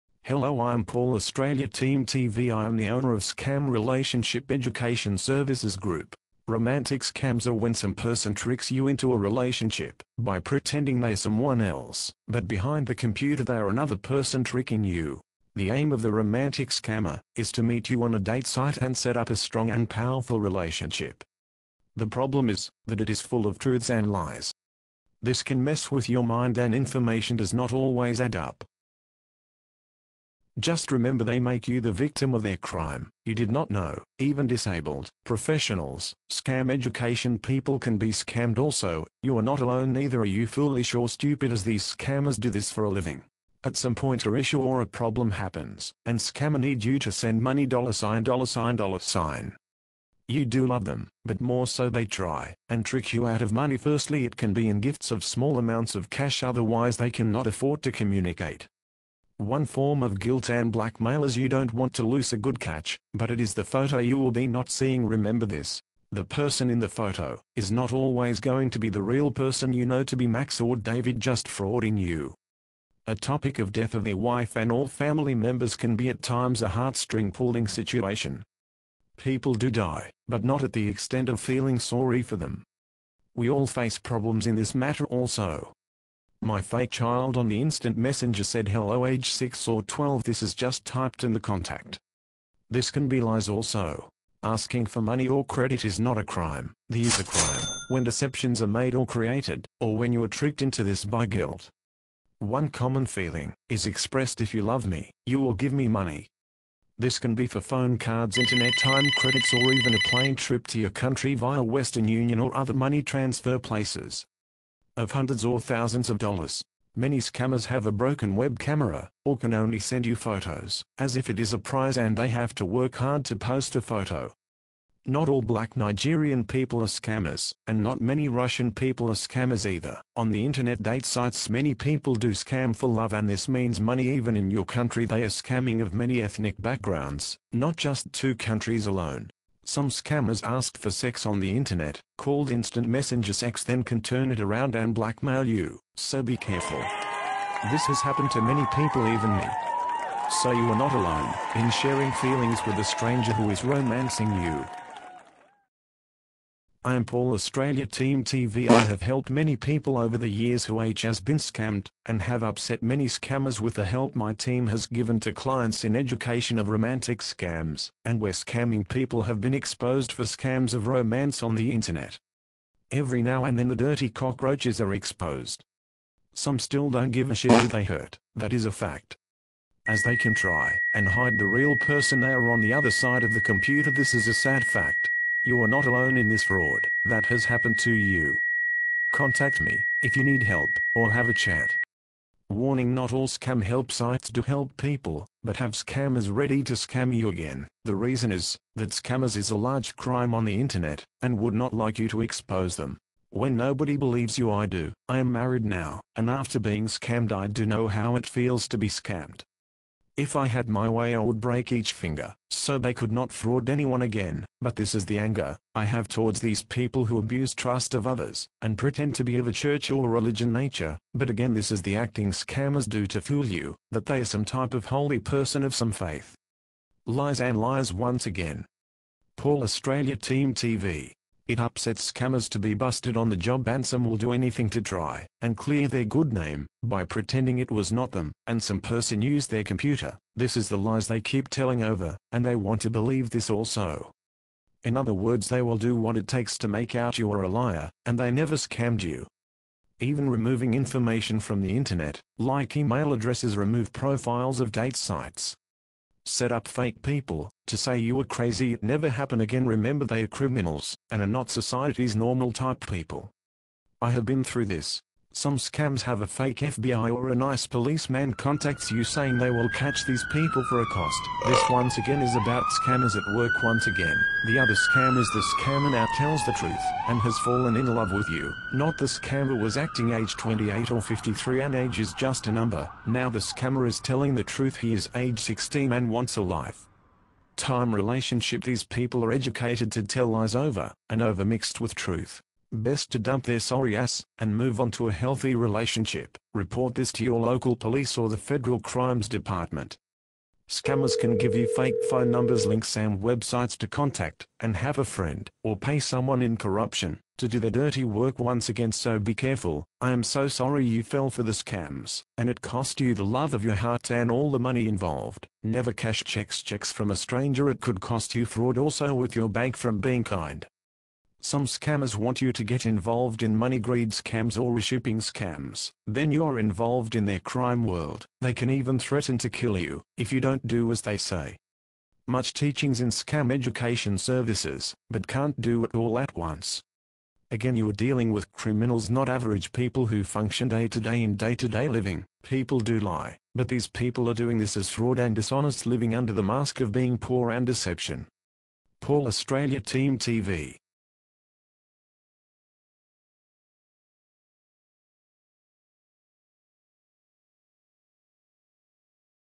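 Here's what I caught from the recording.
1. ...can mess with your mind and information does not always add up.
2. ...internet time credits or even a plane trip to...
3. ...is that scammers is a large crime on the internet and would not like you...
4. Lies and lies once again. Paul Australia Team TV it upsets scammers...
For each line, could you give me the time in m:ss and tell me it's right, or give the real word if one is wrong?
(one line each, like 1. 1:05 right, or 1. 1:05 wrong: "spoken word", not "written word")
1. 0:25 right
2. 1:48 right
3. 3:18 right
4. 3:47 right.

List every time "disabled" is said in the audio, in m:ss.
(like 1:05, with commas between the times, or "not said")
0:34.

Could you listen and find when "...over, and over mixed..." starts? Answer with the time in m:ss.
4:50.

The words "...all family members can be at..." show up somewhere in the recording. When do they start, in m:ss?
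1:14.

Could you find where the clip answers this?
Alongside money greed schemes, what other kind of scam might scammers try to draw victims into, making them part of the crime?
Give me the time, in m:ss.
5:24.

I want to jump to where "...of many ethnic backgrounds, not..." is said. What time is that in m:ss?
2:15.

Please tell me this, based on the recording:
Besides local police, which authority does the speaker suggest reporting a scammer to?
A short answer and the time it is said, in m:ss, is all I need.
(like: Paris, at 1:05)
Federal Crimes Department, at 4:58.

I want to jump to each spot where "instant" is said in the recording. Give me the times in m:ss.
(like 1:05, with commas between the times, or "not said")
1:27, 2:22.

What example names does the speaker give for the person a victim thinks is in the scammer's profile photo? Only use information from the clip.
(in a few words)
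Max or David.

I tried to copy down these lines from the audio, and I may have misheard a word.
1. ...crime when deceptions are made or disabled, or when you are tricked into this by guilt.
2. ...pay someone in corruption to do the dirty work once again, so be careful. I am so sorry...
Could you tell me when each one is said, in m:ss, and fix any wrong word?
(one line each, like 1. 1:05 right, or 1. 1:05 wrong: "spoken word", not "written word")
1. 1:37 wrong: "created", not "disabled"
2. 5:05 right.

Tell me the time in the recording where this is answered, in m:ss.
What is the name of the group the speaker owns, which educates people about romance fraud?
0:03.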